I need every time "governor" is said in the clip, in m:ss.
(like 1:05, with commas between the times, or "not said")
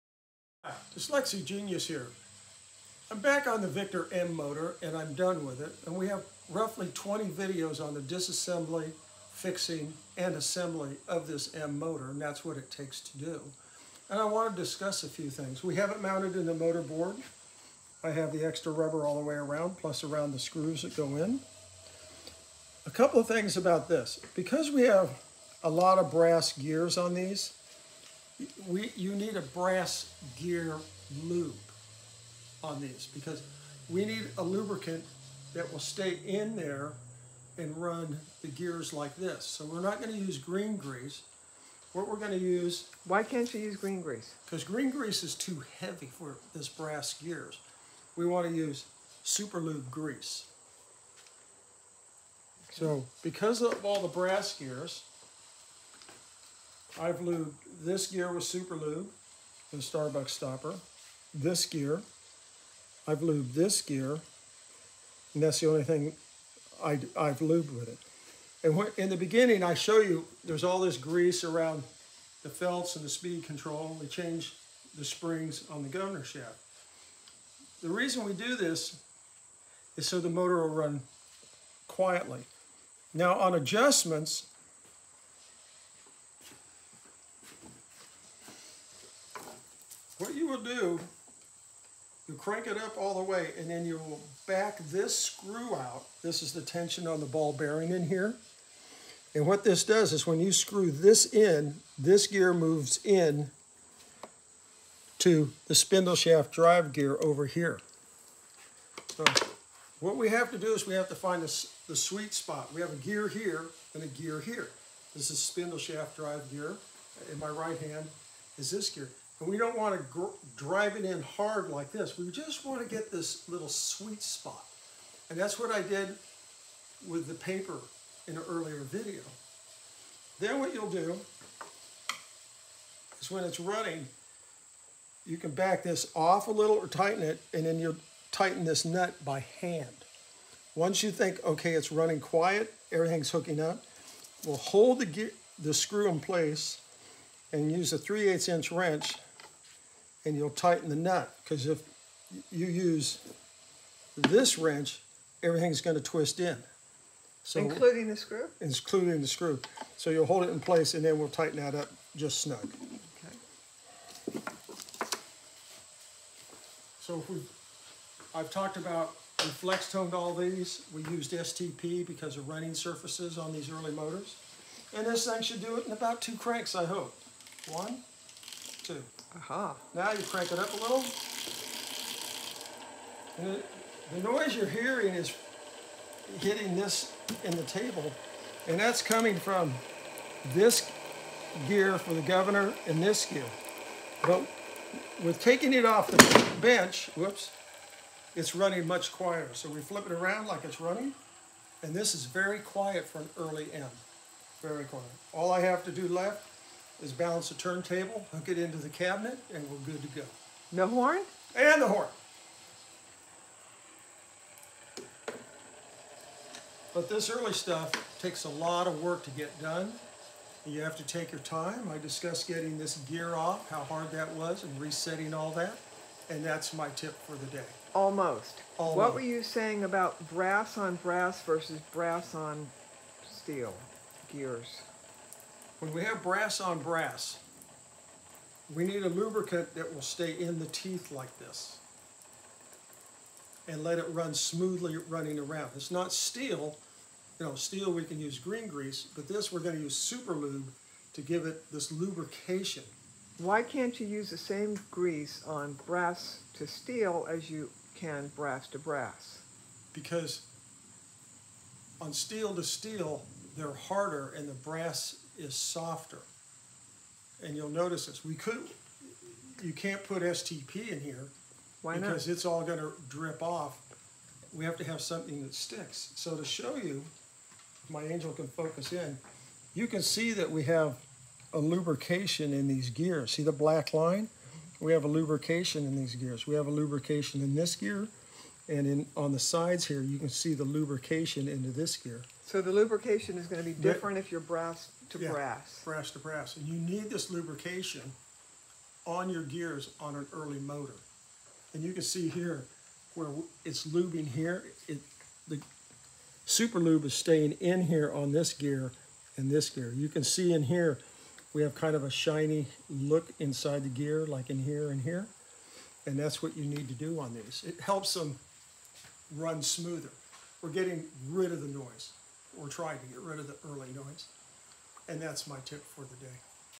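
1:15, 3:12.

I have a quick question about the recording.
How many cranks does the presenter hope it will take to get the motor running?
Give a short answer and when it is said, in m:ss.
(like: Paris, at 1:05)
2, at 2:55.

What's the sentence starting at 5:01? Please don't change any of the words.
And you can see here where it's lubing here.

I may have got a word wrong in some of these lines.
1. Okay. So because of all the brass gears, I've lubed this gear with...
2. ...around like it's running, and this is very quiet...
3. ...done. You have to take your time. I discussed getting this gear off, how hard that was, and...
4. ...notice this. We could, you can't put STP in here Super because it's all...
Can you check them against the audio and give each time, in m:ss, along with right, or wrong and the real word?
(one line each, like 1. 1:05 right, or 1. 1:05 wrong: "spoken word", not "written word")
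1. 0:52 right
2. 3:20 right
3. 3:39 right
4. 4:27 wrong: "Why", not "Super".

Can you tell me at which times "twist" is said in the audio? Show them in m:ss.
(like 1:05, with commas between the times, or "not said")
2:36.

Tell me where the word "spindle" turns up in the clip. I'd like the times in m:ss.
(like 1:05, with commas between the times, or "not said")
1:45, 1:55.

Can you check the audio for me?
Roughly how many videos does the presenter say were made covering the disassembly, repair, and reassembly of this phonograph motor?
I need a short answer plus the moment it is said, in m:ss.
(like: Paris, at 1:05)
20, at 0:06.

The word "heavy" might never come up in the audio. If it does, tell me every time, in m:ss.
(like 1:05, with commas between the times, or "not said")
0:45.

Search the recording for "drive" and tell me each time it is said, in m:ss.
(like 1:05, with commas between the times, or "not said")
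1:46, 1:56, 2:00.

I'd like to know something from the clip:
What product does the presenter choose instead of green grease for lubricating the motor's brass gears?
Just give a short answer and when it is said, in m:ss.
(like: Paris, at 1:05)
Super Lube grease, at 0:49.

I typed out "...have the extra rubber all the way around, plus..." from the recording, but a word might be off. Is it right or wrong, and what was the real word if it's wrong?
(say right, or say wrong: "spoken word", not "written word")
right.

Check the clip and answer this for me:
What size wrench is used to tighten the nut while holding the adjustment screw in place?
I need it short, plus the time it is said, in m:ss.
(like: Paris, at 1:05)
3/8 inch, at 2:27.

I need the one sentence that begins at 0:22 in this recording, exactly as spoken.
A couple of things about this.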